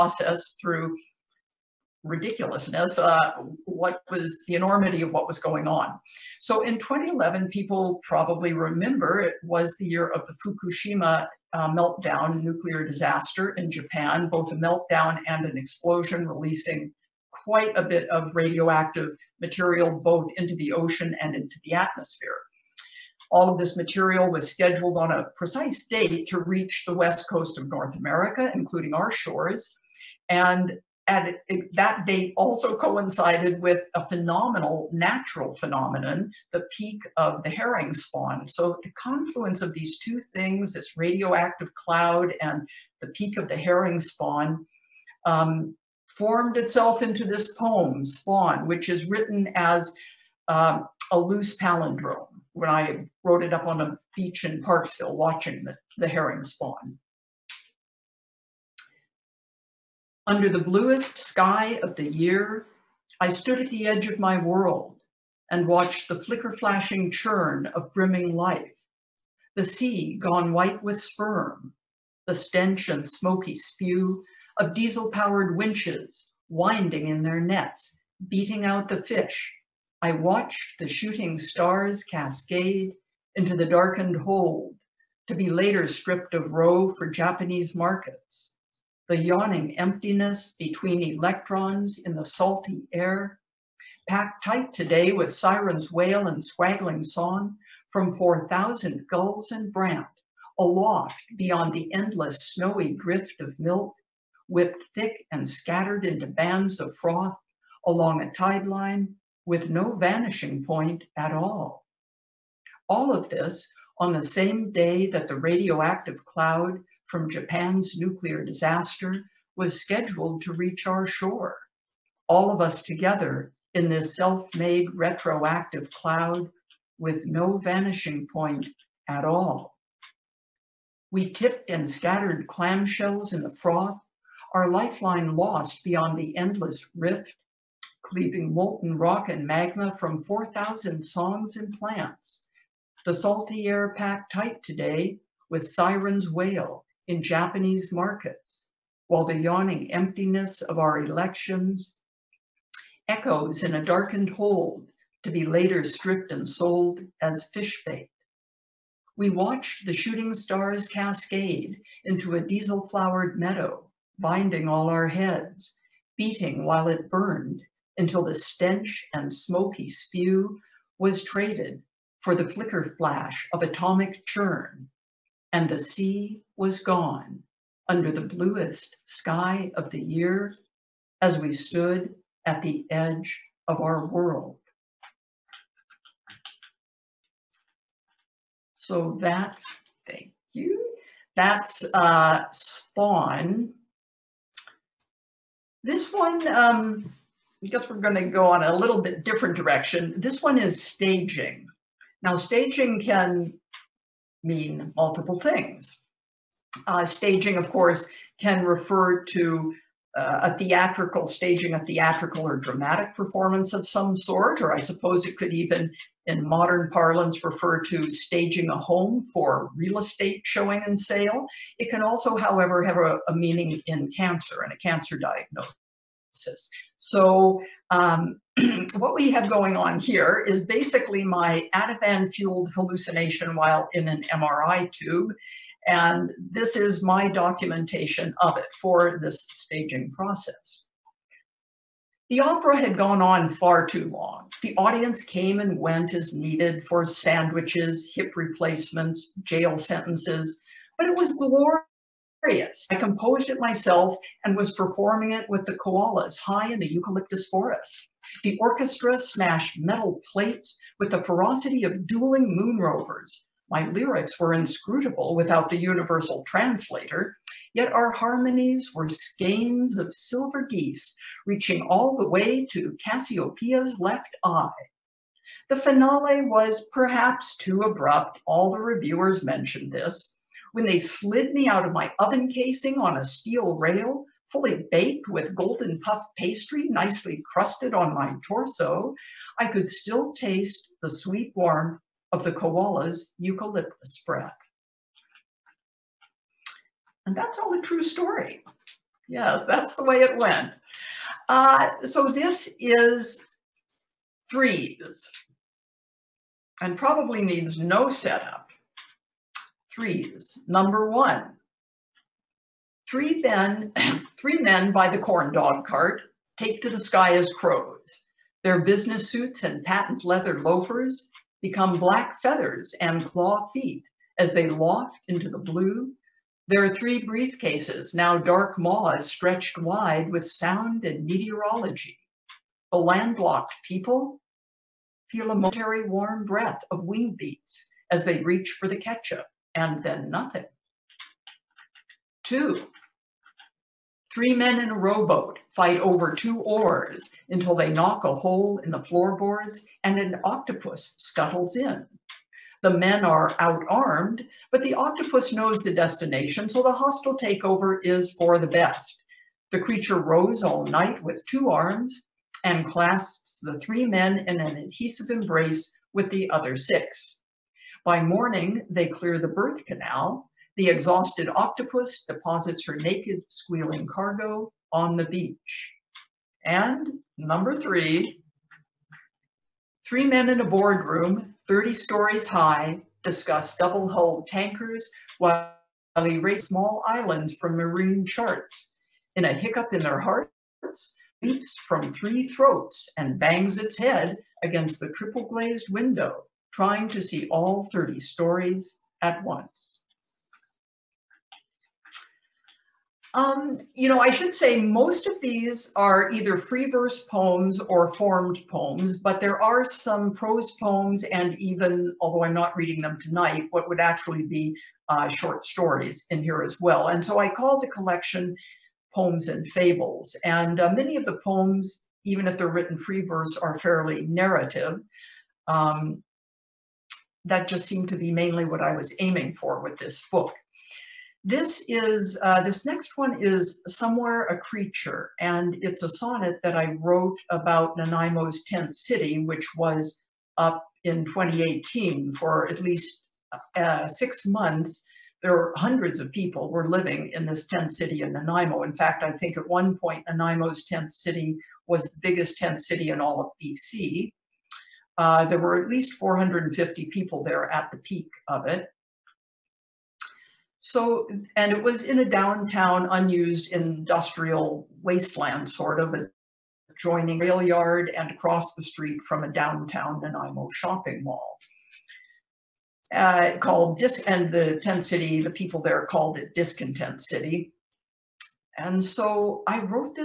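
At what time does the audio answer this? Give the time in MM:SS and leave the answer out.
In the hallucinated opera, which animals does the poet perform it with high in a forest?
04:15.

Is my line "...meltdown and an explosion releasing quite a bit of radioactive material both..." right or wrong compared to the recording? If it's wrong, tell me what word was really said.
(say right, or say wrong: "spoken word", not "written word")
right.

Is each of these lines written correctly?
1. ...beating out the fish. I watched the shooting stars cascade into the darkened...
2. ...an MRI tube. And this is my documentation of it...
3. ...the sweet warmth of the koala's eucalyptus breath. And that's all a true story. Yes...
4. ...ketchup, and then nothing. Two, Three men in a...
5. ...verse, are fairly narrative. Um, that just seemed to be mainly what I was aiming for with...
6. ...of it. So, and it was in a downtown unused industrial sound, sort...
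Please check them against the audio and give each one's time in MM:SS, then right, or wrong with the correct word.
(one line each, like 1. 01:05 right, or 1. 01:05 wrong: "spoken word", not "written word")
1. 01:18 right
2. 03:54 right
3. 04:51 right
4. 05:38 right
5. 07:03 right
6. 07:38 wrong: "wasteland", not "sound".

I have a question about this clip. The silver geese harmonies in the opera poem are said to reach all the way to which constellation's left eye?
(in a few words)
Cassiopeia.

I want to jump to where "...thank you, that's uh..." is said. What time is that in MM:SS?
03:10.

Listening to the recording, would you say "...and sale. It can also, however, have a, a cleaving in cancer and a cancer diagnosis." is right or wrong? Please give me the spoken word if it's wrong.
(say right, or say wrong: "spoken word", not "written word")
wrong: "meaning", not "cleaving".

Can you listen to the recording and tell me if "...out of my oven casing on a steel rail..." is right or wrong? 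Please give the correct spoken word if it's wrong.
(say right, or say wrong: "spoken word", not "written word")
right.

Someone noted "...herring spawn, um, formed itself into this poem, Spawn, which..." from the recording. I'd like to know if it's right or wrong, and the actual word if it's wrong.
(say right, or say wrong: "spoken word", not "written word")
right.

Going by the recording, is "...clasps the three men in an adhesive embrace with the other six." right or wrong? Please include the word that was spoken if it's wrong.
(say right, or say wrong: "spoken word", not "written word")
right.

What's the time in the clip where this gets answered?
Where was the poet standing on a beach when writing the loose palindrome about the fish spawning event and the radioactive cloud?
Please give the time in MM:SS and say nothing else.
00:54.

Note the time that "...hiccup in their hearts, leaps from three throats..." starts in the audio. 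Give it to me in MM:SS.
06:29.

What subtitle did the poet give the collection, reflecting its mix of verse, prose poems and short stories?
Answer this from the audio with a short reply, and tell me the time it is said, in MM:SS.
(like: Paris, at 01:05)
Poems and Fables, at 06:59.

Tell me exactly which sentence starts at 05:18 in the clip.
Their business suits and patent leather loafers become black feathers and claw feet as they loft into the blue.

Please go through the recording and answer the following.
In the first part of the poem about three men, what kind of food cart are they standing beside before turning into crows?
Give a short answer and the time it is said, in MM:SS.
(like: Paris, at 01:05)
corn dog cart, at 05:15.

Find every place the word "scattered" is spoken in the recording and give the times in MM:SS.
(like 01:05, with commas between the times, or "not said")
01:45, 02:11.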